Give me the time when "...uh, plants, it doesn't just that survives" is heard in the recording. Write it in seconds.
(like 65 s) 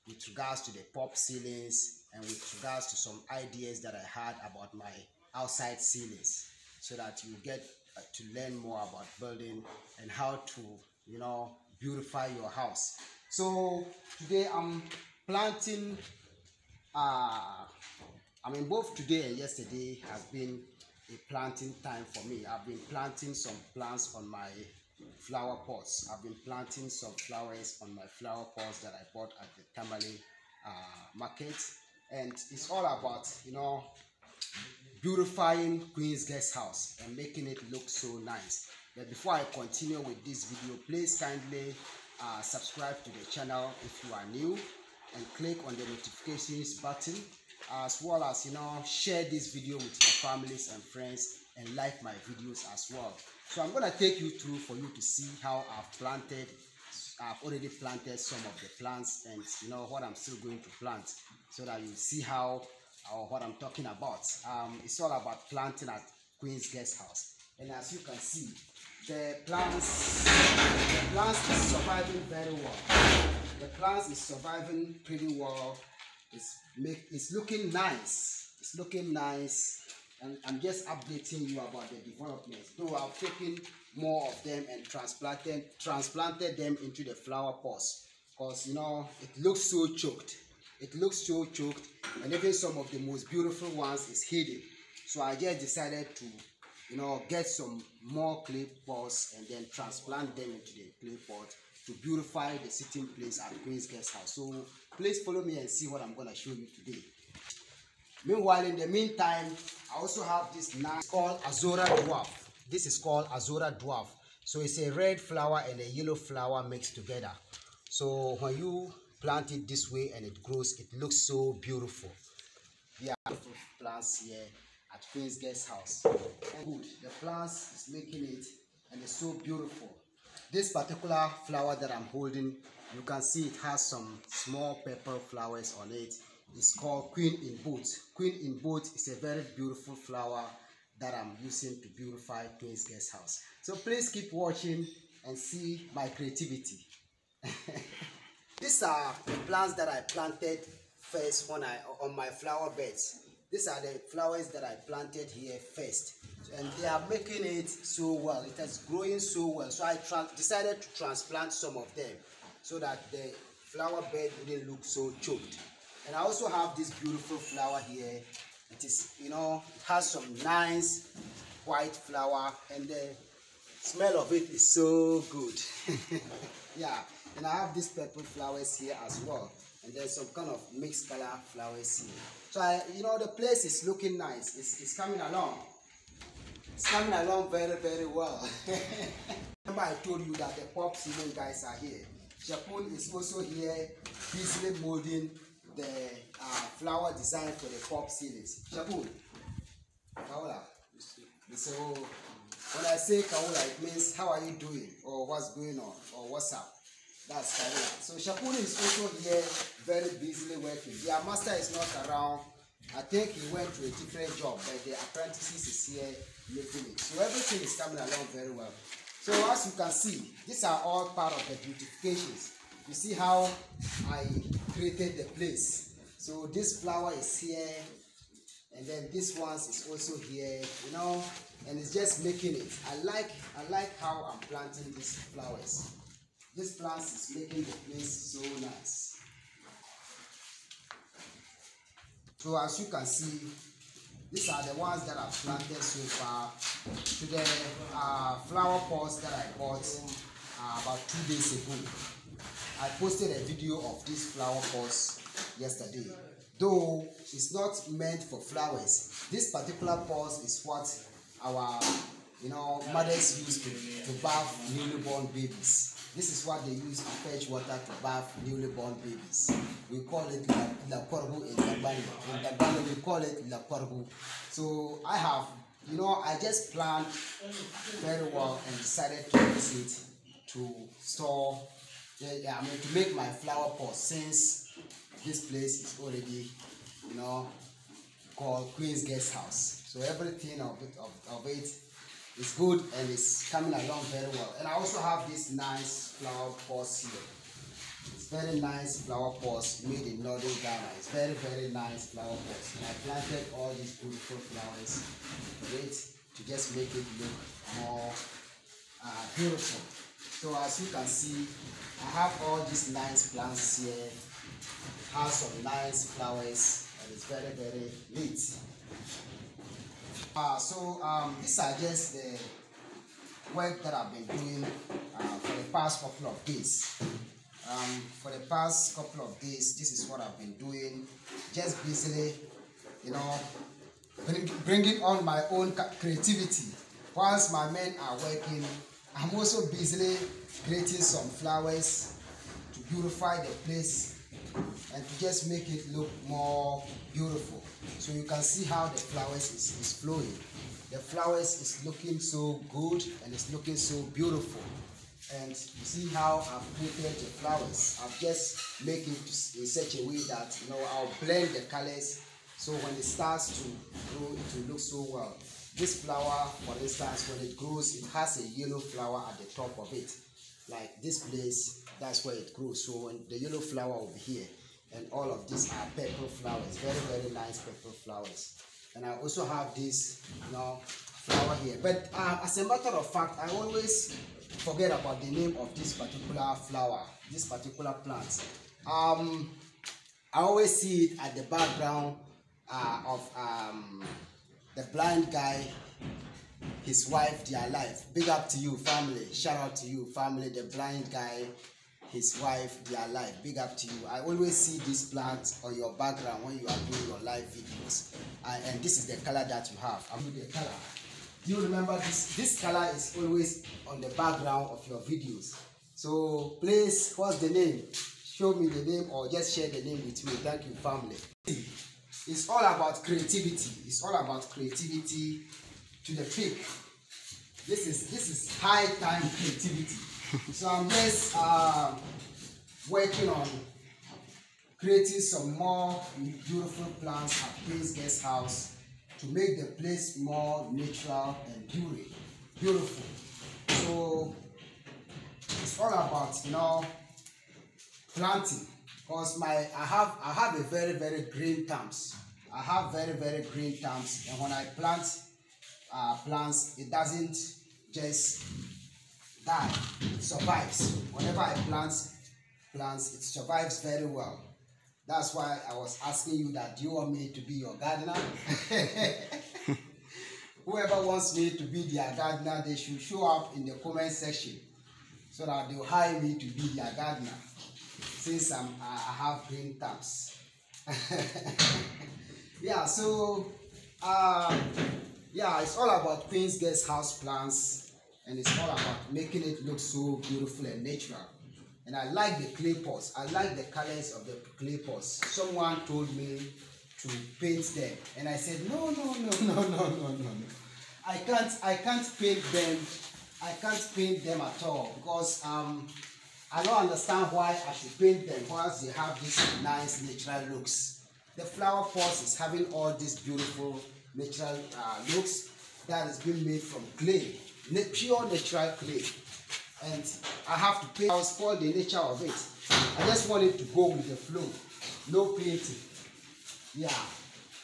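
455 s.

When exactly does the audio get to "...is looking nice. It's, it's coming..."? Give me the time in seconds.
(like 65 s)
183 s.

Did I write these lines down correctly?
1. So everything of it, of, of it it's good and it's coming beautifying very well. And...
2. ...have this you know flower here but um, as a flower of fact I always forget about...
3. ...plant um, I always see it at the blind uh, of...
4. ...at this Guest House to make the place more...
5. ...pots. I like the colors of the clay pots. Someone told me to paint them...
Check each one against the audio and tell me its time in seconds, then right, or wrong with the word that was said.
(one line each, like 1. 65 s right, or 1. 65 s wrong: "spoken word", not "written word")
1. 289 s wrong: "along", not "beautifying"
2. 379 s wrong: "matter", not "flower"
3. 388 s wrong: "background", not "blind"
4. 437 s right
5. 492 s right.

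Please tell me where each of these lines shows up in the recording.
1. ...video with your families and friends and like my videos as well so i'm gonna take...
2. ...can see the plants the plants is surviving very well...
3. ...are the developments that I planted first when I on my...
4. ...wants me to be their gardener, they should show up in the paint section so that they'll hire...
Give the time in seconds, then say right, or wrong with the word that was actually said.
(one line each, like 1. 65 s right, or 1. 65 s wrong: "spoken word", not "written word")
1. 49 s right
2. 67 s right
3. 148 s wrong: "plants", not "developments"
4. 471 s wrong: "comment", not "paint".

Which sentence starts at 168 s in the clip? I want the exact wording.
It is, you know, it has some nice white flower and the smell of it is so good.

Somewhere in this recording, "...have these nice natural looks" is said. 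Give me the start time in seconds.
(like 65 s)
508 s.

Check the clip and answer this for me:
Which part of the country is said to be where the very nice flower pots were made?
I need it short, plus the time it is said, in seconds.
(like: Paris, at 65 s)
northern Ghana, at 300 s.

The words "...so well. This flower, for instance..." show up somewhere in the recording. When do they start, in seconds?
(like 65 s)
364 s.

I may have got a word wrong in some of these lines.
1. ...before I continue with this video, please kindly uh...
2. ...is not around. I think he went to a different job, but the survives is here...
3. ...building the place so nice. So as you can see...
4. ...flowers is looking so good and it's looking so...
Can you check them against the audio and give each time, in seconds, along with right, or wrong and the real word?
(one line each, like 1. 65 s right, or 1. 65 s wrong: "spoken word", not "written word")
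1. 39 s right
2. 211 s wrong: "apprentices", not "survives"
3. 237 s wrong: "making", not "building"
4. 350 s right.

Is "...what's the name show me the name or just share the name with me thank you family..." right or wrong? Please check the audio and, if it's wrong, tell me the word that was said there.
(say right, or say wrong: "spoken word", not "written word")
right.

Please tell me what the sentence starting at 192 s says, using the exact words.
Japan is also here busily molding the uh, flower design for the pop ceilings.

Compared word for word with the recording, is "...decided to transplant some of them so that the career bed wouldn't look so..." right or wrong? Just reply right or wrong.
wrong.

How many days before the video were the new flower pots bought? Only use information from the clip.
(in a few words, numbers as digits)
2.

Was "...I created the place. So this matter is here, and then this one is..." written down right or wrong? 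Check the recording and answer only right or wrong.
wrong.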